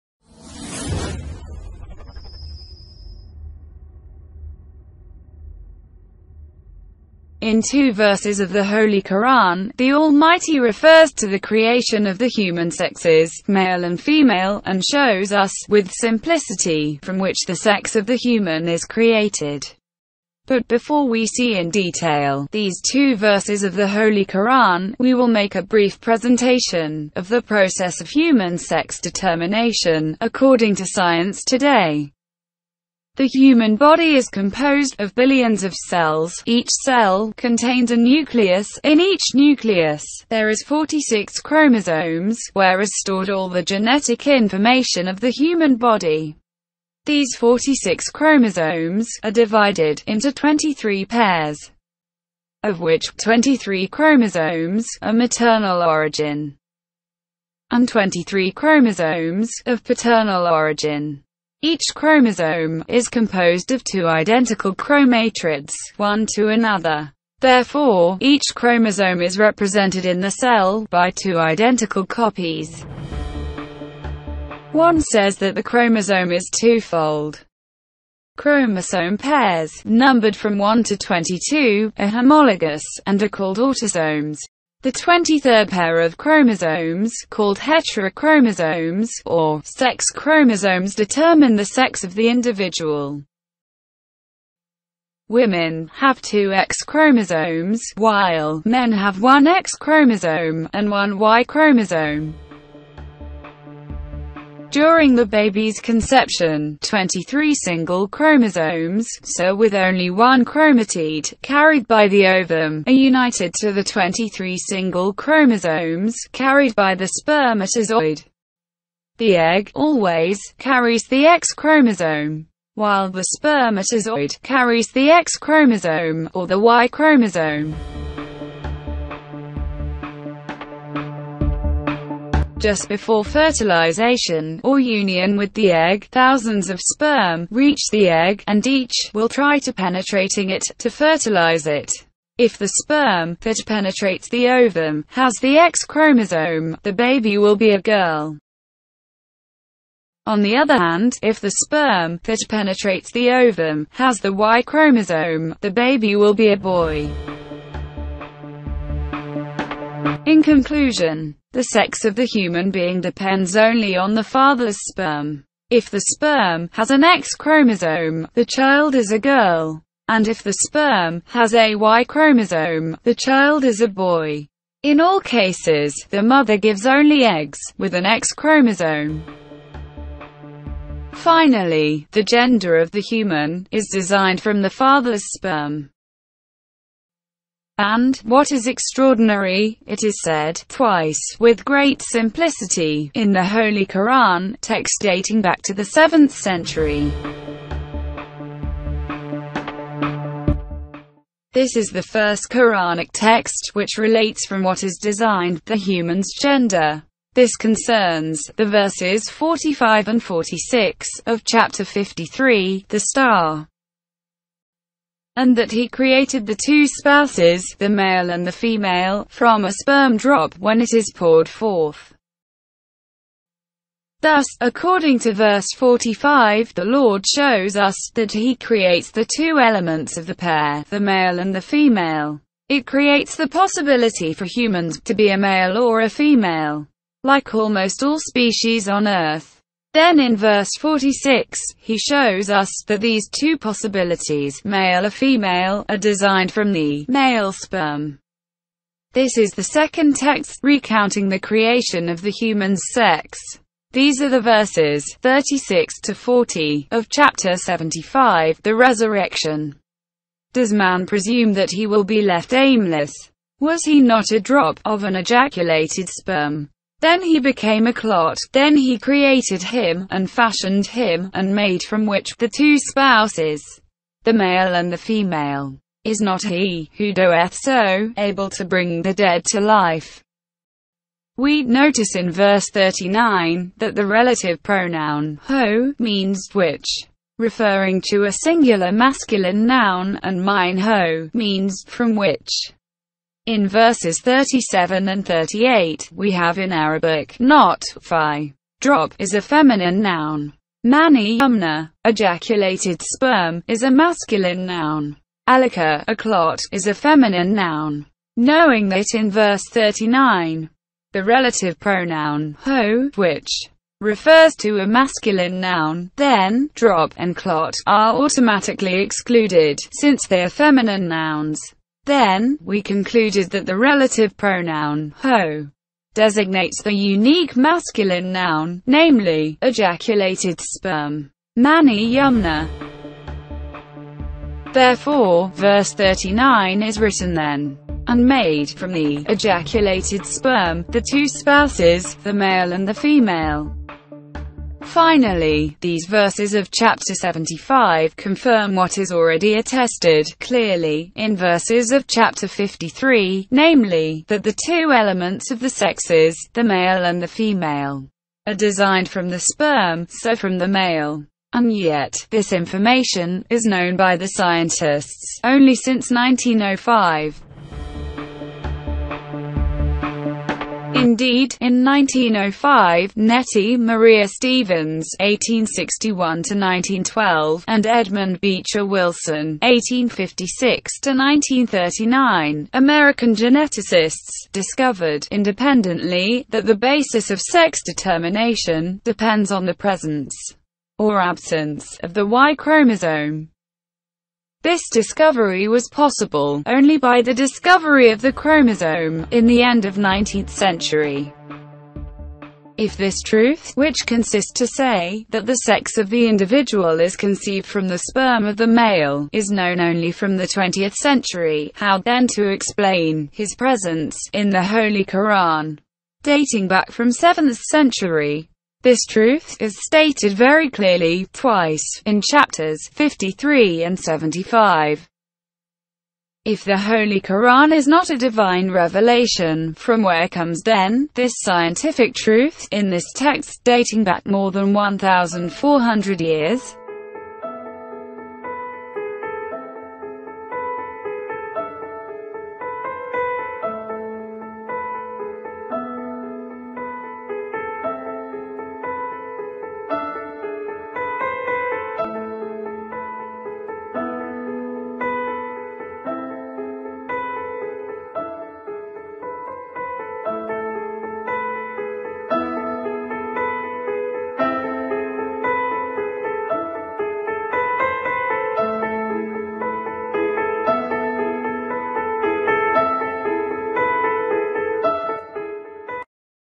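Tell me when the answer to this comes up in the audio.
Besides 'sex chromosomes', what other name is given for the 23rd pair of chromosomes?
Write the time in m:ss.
1:27.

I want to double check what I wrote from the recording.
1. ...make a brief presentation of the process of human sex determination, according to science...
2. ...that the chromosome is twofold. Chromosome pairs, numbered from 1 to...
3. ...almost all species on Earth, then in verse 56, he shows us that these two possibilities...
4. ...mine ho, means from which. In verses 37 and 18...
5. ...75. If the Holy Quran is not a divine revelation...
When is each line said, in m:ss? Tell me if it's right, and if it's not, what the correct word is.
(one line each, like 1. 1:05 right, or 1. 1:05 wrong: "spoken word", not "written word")
1. 0:25 right
2. 1:15 right
3. 3:57 wrong: "46", not "56"
4. 4:50 wrong: "38", not "18"
5. 7:03 right.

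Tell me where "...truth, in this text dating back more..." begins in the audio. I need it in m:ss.
7:12.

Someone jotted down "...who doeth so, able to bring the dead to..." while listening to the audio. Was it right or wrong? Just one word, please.
right.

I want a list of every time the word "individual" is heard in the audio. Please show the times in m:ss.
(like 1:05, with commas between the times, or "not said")
1:32, 6:46.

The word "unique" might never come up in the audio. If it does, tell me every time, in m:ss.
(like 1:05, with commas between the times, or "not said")
5:26.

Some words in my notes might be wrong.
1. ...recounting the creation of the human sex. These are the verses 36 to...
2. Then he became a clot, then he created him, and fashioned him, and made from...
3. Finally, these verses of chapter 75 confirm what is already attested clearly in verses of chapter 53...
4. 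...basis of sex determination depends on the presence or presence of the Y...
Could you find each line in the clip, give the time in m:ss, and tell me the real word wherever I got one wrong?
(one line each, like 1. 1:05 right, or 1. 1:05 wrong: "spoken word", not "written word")
1. 4:10 right
2. 4:27 right
3. 5:44 right
4. 6:26 wrong: "absence", not "presence".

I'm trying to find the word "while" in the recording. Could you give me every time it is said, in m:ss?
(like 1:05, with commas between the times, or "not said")
1:37, 2:02.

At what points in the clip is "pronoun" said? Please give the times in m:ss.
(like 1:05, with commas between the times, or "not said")
4:44, 5:11, 5:24.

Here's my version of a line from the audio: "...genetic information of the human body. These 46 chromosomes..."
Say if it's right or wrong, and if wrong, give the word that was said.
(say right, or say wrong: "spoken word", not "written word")
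right.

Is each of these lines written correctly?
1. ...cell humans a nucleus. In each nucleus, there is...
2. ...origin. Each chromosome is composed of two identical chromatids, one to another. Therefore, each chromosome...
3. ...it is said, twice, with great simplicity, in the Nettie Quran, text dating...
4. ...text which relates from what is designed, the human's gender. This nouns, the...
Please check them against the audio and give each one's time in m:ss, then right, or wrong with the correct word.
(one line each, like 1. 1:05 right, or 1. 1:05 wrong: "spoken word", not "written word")
1. 0:36 wrong: "contains", not "humans"
2. 1:00 right
3. 3:09 wrong: "Holy", not "Nettie"
4. 3:23 wrong: "concerns", not "nouns".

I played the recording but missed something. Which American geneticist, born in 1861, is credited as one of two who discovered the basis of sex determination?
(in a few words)
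Nettie Maria Stevens.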